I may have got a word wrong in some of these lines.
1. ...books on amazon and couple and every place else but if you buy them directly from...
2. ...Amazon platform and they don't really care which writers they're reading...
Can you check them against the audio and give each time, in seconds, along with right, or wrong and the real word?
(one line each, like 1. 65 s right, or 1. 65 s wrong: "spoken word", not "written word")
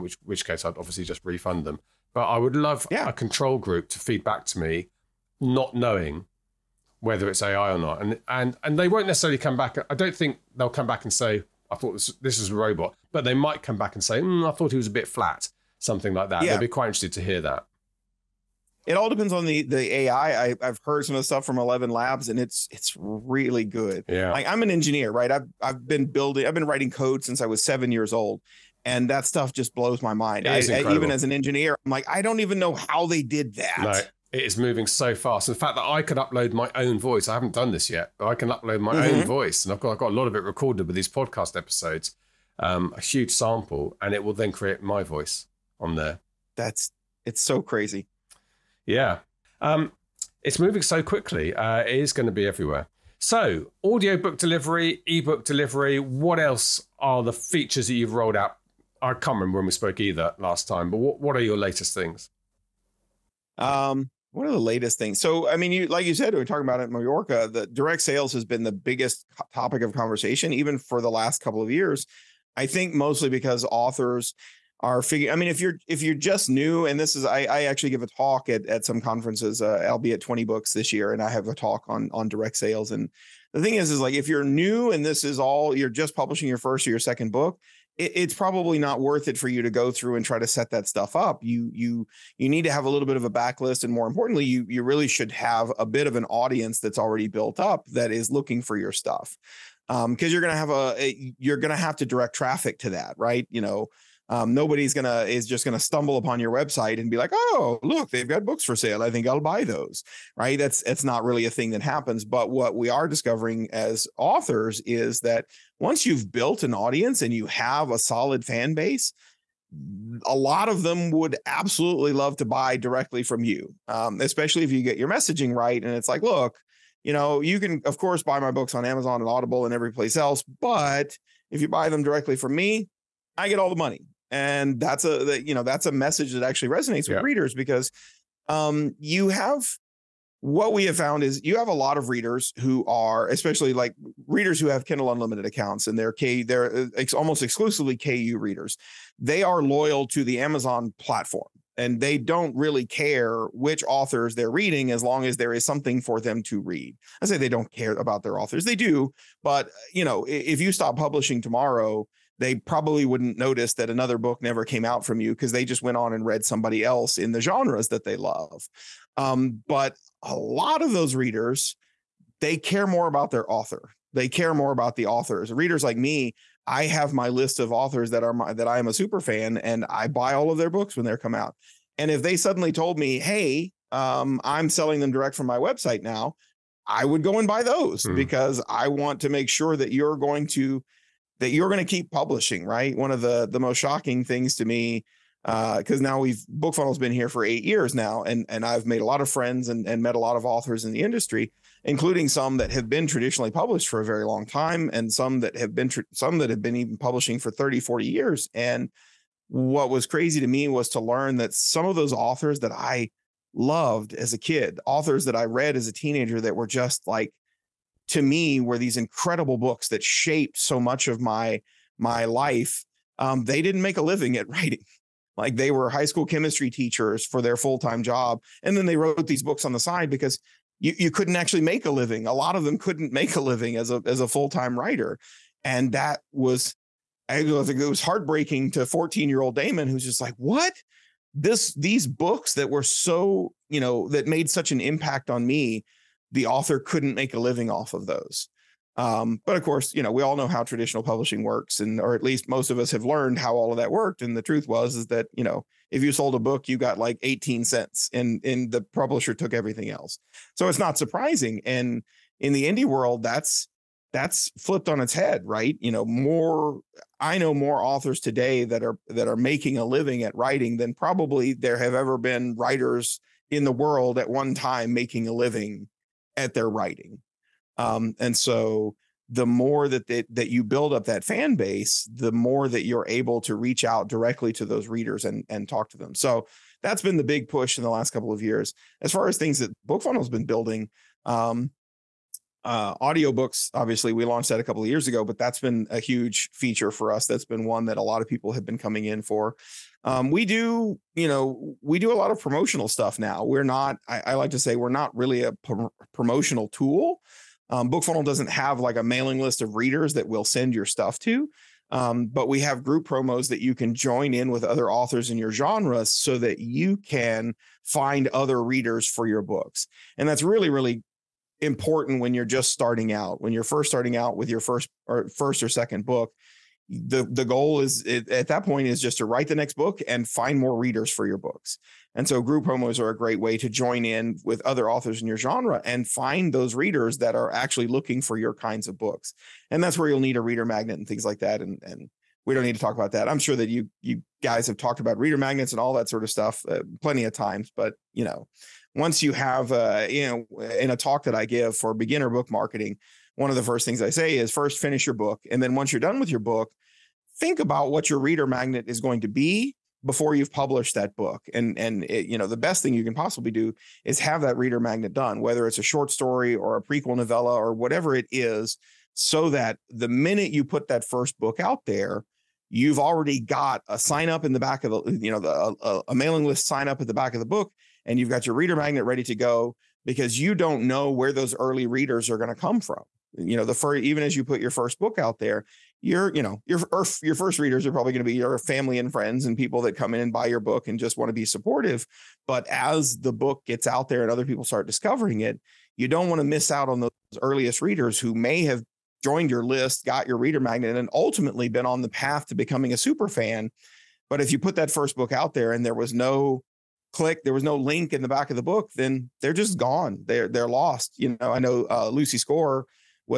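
1. 128 s wrong: "audible", not "couple"
2. 150 s wrong: "authors", not "writers".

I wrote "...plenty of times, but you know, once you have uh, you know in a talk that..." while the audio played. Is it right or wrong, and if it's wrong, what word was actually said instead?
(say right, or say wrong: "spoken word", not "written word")
right.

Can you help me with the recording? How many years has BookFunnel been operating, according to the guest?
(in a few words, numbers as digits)
8.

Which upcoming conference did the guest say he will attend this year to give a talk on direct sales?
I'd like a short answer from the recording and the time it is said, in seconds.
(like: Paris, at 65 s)
Twenty Books, at 80 s.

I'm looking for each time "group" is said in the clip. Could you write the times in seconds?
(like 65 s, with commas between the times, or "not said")
3 s, 312 s, 332 s.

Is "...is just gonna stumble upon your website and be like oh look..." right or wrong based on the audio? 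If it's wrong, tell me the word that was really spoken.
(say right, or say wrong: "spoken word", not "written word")
right.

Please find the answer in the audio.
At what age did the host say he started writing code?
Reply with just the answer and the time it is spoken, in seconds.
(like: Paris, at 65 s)
7, at 27 s.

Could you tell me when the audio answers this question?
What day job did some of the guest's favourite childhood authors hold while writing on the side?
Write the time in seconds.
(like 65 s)
225 s.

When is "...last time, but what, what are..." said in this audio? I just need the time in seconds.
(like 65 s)
60 s.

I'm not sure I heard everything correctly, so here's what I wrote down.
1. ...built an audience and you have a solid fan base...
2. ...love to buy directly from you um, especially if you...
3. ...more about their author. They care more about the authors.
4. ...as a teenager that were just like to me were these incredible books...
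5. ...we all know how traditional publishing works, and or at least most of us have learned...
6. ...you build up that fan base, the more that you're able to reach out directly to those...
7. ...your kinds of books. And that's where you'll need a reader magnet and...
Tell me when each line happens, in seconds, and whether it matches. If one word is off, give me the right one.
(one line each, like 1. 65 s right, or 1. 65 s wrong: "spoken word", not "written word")
1. 116 s right
2. 122 s right
3. 172 s right
4. 215 s right
5. 250 s right
6. 280 s right
7. 338 s right.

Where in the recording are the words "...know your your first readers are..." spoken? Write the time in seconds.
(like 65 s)
386 s.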